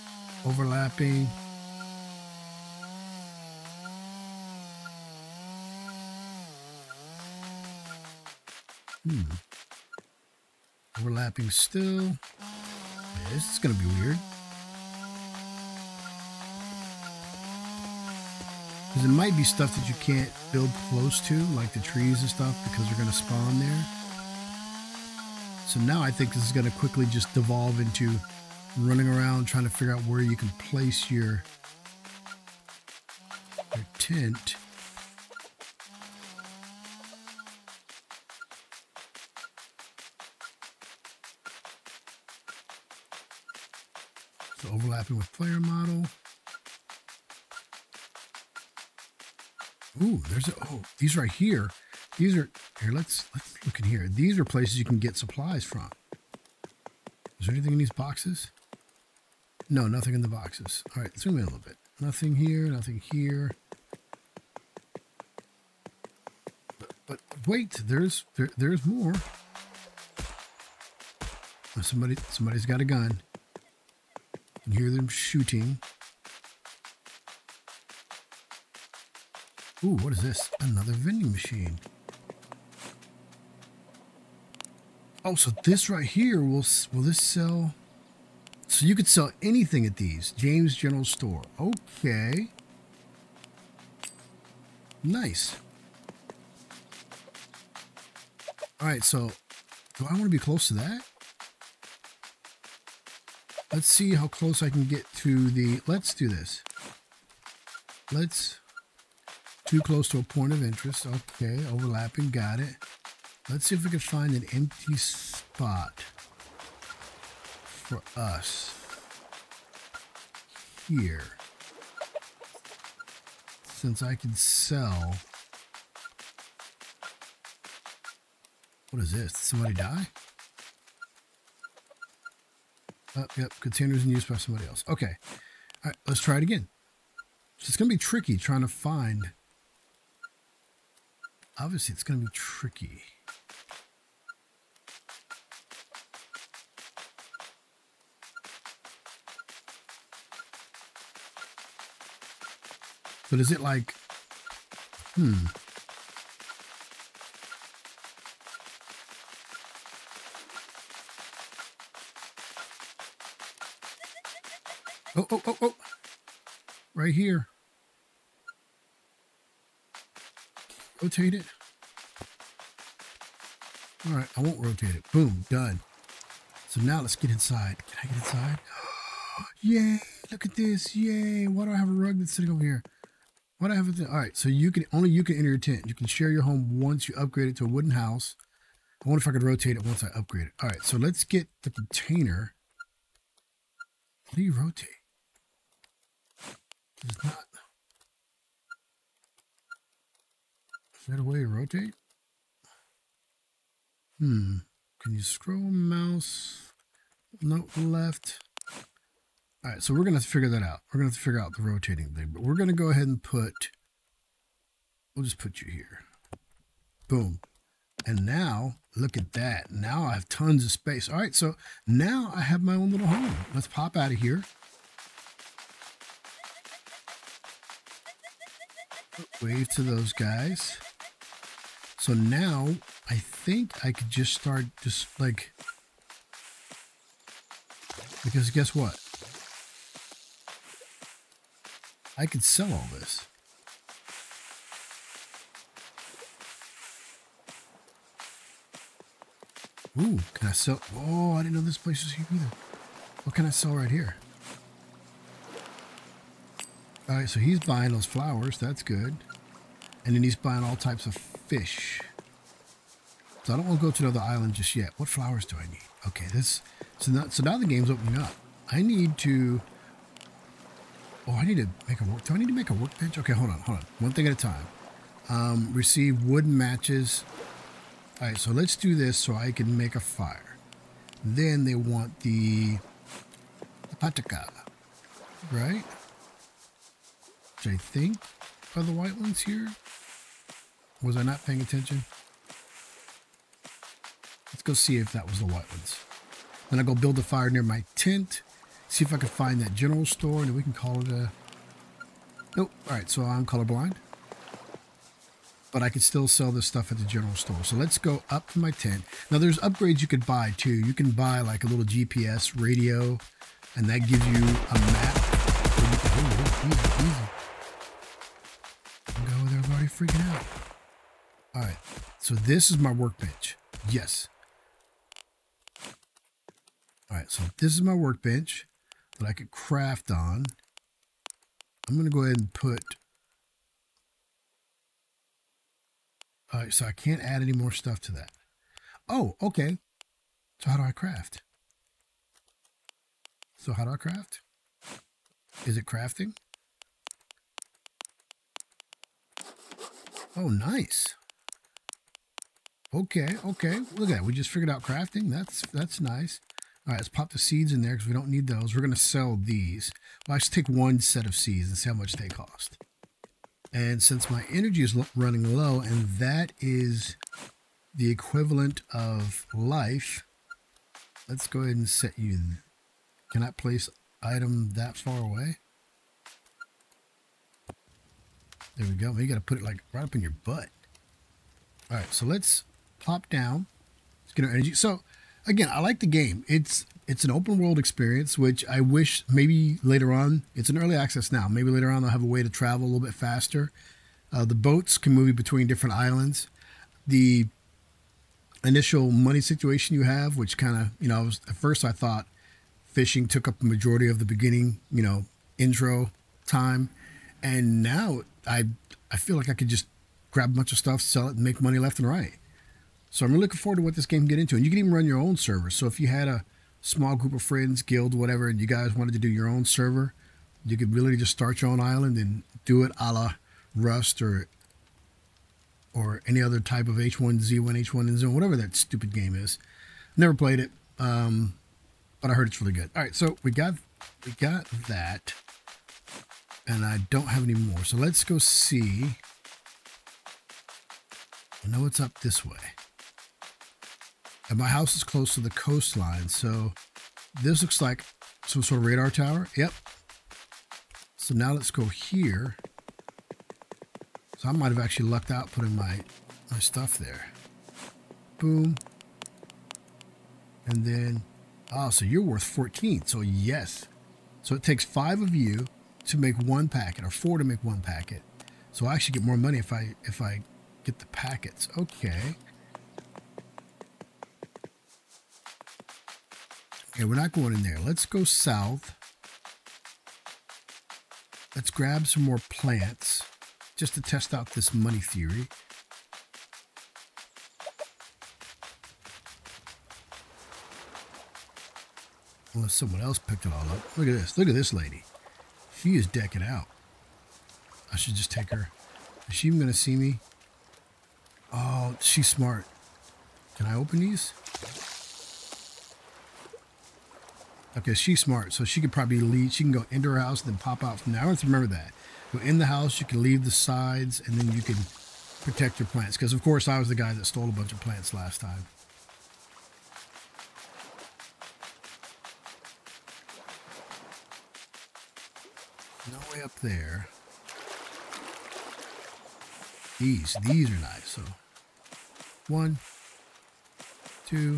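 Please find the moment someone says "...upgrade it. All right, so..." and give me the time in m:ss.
3:10.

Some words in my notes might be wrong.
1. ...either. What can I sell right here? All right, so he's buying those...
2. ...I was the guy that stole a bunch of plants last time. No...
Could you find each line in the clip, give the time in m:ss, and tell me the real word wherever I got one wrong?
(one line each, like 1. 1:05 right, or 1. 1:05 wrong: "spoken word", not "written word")
1. 4:12 right
2. 8:36 right.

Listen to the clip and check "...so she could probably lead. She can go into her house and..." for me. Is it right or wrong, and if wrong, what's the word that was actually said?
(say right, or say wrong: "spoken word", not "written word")
right.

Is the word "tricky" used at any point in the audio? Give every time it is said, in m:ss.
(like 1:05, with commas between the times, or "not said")
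2:17, 2:22.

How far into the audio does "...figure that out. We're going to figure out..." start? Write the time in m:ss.
3:30.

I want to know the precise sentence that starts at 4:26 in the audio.
So now, so now the game's opening up.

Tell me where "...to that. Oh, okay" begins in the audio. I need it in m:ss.
5:38.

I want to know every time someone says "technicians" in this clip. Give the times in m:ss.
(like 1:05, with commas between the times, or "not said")
not said.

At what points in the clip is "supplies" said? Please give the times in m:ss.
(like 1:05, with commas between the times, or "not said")
0:55.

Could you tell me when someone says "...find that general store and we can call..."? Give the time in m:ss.
4:59.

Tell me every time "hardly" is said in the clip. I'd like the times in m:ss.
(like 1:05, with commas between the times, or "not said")
not said.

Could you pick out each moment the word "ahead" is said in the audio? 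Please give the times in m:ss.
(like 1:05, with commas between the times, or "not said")
3:32, 5:32, 6:11.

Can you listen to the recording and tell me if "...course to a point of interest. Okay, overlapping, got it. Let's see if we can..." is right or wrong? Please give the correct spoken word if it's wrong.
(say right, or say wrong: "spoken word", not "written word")
wrong: "close", not "course".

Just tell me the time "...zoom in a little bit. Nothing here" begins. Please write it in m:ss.
1:01.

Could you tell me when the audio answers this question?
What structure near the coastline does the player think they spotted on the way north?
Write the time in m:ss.
7:28.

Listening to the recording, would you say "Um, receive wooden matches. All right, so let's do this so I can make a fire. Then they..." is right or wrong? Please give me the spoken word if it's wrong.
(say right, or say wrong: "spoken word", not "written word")
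right.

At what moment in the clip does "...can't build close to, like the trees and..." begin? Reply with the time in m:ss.
0:19.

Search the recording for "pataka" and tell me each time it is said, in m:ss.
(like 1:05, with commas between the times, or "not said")
4:43.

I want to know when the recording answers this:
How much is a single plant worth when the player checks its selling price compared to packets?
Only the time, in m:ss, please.
7:42.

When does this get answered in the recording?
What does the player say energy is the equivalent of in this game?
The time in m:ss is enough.
6:09.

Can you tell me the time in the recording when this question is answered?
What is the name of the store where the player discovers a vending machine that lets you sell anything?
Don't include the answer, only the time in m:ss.
1:30.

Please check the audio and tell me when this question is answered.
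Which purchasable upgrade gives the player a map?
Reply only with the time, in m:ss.
5:11.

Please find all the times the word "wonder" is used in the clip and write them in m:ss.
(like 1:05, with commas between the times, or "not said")
3:09.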